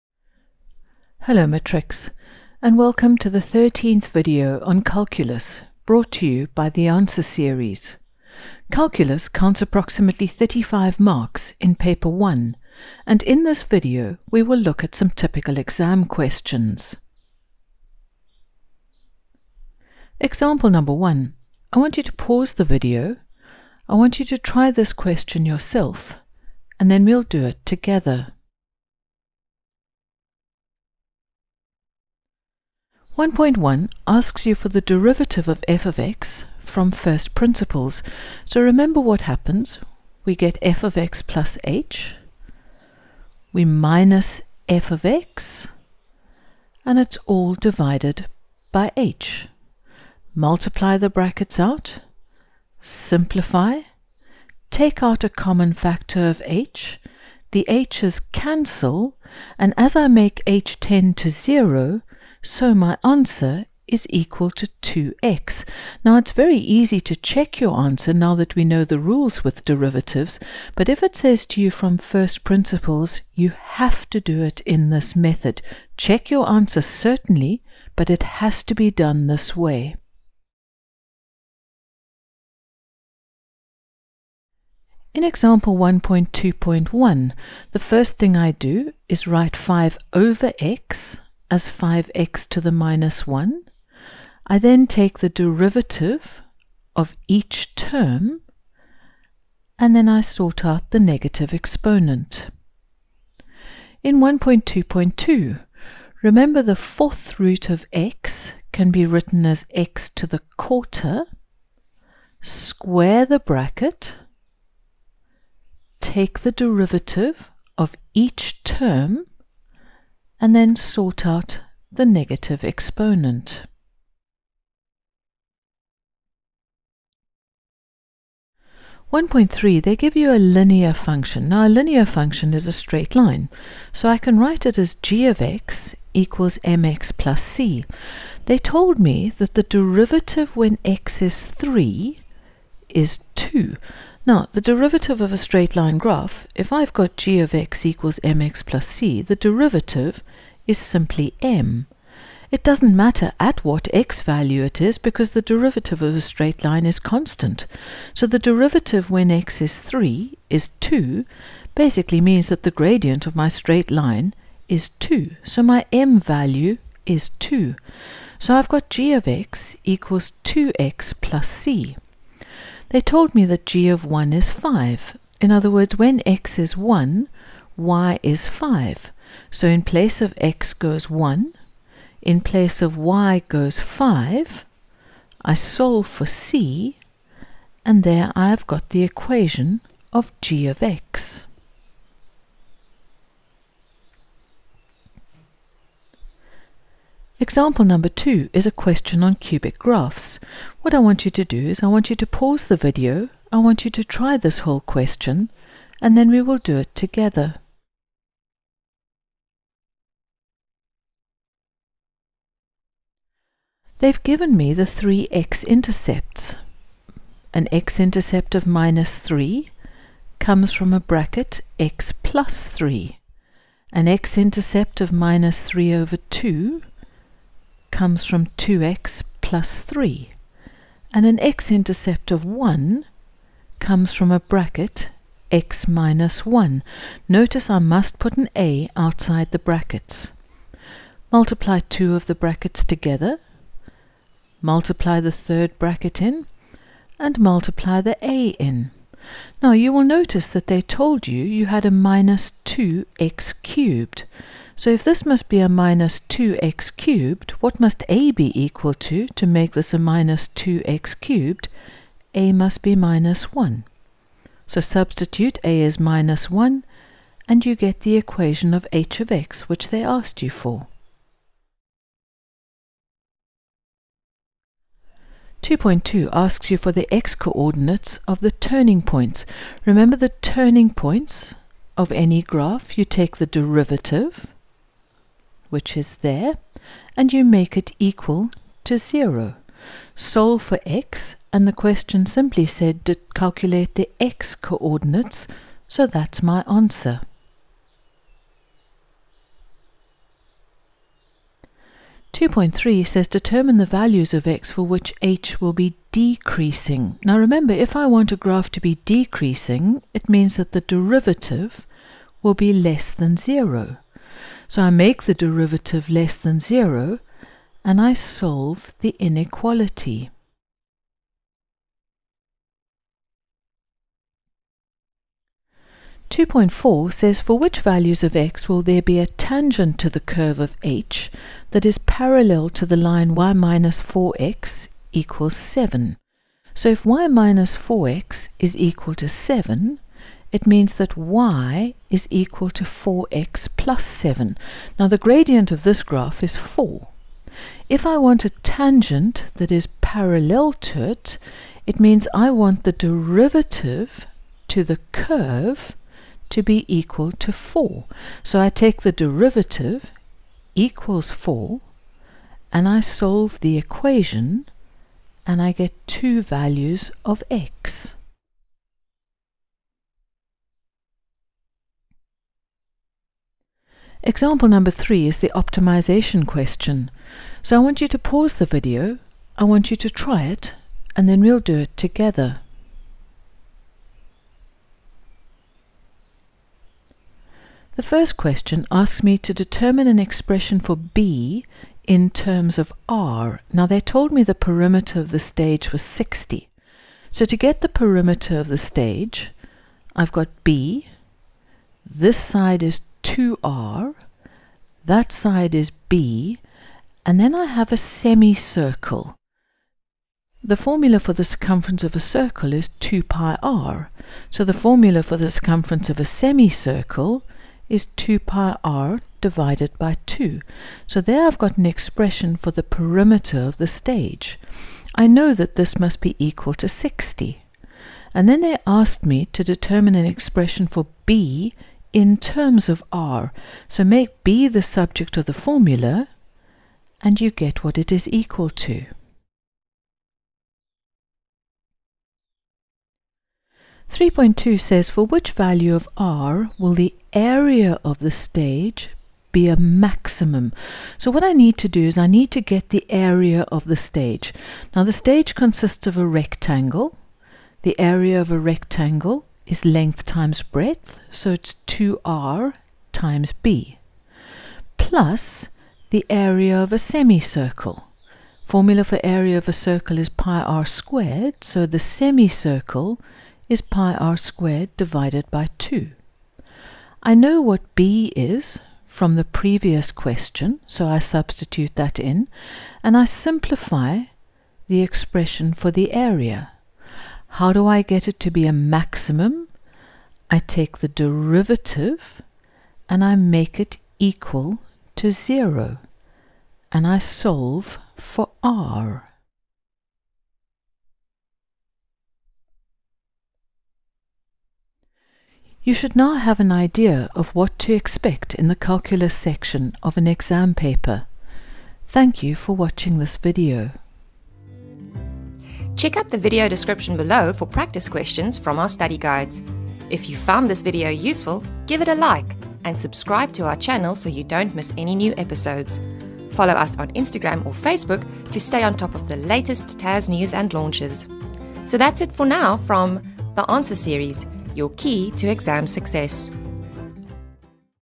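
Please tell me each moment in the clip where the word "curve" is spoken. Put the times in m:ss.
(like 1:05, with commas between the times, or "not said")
5:30, 5:55.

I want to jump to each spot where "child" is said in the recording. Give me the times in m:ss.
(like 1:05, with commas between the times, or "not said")
not said.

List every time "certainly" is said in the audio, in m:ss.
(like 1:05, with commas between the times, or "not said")
1:16.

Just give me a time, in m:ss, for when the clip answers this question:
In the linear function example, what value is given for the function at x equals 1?
2:53.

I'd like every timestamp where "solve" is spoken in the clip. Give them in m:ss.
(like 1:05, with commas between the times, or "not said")
3:05, 4:50, 5:18, 6:02, 8:17.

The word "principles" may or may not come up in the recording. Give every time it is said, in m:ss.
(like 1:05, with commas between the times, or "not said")
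0:37, 1:12.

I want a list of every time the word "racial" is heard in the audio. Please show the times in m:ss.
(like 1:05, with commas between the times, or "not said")
not said.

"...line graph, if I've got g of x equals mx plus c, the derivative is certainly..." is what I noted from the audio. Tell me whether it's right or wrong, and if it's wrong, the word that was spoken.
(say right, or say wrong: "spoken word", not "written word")
wrong: "simply", not "certainly".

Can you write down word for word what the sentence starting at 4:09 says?
Now you will notice that they told you you had a minus 2x cubed.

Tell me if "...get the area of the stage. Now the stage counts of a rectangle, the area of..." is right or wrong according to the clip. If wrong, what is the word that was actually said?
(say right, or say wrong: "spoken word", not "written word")
wrong: "consists", not "counts".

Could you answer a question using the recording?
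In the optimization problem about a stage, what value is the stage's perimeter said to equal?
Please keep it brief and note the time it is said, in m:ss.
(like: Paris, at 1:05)
60, at 6:34.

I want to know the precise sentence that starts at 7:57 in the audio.
I know what b is from the previous question, so I substitute that in, and I simplify the expression for the area.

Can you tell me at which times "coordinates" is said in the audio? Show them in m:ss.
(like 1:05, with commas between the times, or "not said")
4:37, 4:54.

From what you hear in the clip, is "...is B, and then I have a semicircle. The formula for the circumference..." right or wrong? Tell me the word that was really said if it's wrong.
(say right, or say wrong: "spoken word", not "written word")
right.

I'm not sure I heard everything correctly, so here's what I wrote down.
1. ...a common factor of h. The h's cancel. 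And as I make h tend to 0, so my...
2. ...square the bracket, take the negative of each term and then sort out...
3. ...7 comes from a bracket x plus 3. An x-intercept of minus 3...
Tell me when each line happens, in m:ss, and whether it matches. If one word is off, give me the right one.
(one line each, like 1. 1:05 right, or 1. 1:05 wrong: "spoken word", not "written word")
1. 0:55 right
2. 1:52 wrong: "derivative", not "negative"
3. 3:39 wrong: "3", not "7".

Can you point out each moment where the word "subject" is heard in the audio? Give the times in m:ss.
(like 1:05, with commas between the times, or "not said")
7:14.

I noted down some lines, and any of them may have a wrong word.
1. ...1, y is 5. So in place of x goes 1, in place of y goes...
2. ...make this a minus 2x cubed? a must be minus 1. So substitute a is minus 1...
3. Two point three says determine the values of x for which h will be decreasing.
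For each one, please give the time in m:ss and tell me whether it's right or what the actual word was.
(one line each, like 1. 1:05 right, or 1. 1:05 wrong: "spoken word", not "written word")
1. 2:56 right
2. 4:19 right
3. 5:02 right.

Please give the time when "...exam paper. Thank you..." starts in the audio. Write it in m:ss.
8:30.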